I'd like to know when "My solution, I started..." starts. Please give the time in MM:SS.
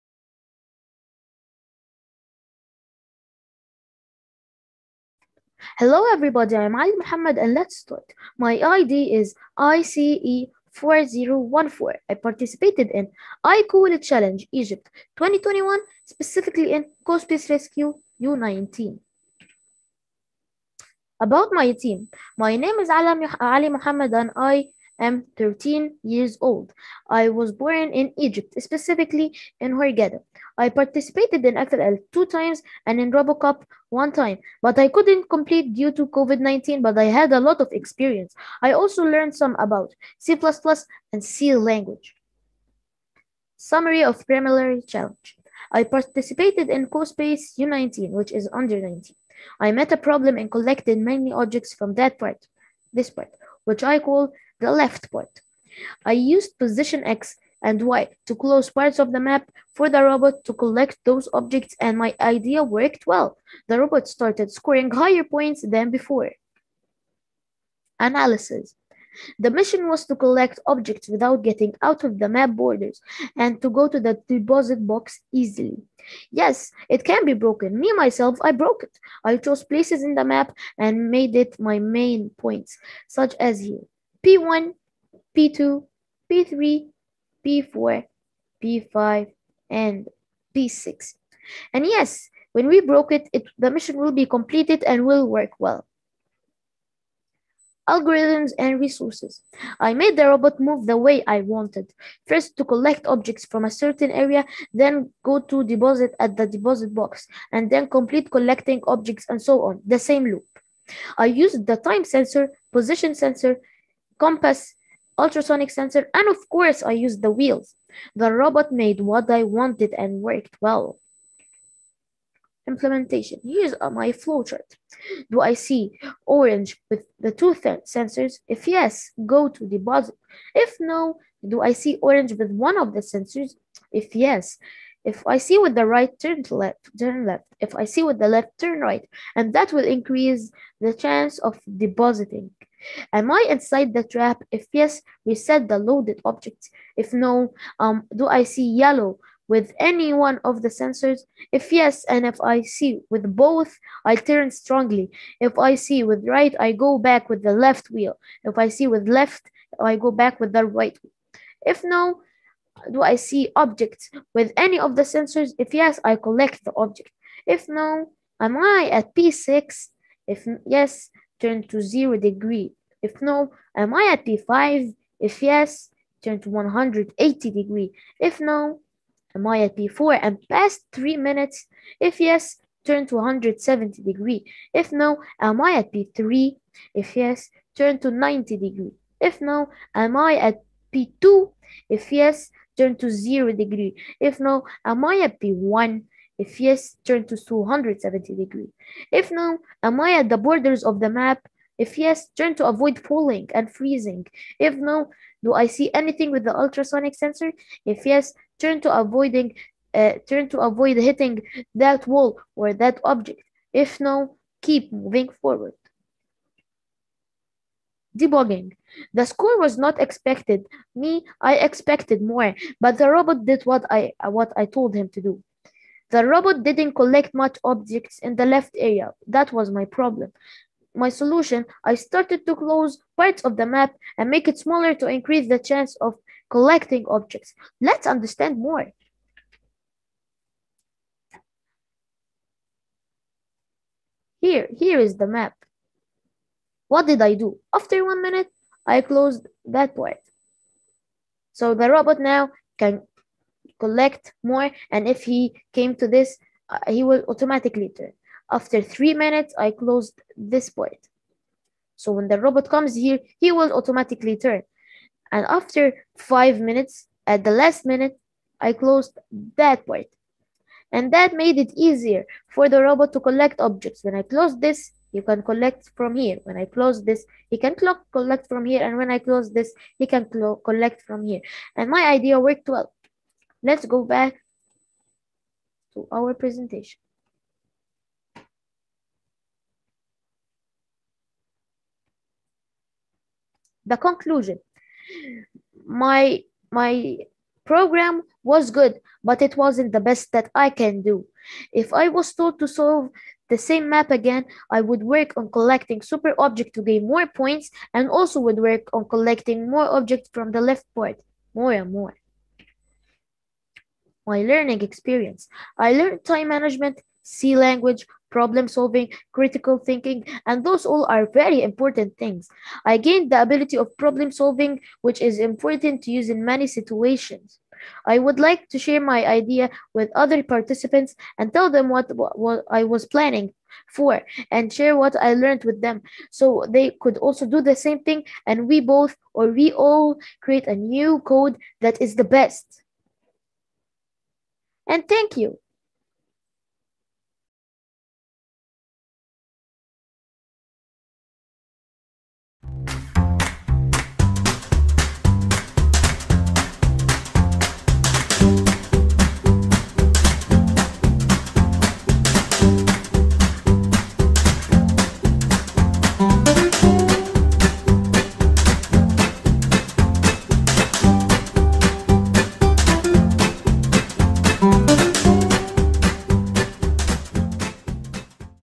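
03:50.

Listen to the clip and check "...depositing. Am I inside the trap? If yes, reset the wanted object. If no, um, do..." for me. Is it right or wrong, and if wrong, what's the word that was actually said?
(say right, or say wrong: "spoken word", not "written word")
wrong: "loaded", not "wanted".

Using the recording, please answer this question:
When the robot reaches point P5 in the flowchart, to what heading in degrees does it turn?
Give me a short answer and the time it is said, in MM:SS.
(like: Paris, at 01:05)
180 degrees, at 02:56.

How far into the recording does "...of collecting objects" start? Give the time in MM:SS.
03:56.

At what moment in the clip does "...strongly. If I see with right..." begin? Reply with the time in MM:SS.
02:34.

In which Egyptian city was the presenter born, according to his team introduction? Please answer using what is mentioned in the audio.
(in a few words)
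Hurghada.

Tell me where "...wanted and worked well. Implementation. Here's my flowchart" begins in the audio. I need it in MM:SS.
01:59.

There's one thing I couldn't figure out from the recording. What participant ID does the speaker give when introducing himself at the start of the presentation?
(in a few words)
ICE4014.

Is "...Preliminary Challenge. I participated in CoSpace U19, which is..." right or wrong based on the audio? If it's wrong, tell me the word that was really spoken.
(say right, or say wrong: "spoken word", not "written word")
right.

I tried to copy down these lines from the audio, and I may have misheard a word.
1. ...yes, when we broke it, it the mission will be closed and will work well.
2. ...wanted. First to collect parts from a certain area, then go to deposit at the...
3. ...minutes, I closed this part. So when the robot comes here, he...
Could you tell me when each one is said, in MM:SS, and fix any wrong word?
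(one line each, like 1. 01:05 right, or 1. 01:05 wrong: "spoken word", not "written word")
1. 01:31 wrong: "completed", not "closed"
2. 01:41 wrong: "objects", not "parts"
3. 04:19 right.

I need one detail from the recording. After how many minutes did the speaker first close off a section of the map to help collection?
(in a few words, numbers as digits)
1 minute.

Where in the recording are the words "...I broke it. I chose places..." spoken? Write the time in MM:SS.
01:18.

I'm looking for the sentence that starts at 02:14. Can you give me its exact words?
If yes, if I see with the right, turn left, turn left.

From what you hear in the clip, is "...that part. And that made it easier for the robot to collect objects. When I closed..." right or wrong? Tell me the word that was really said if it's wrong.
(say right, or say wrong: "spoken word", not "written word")
right.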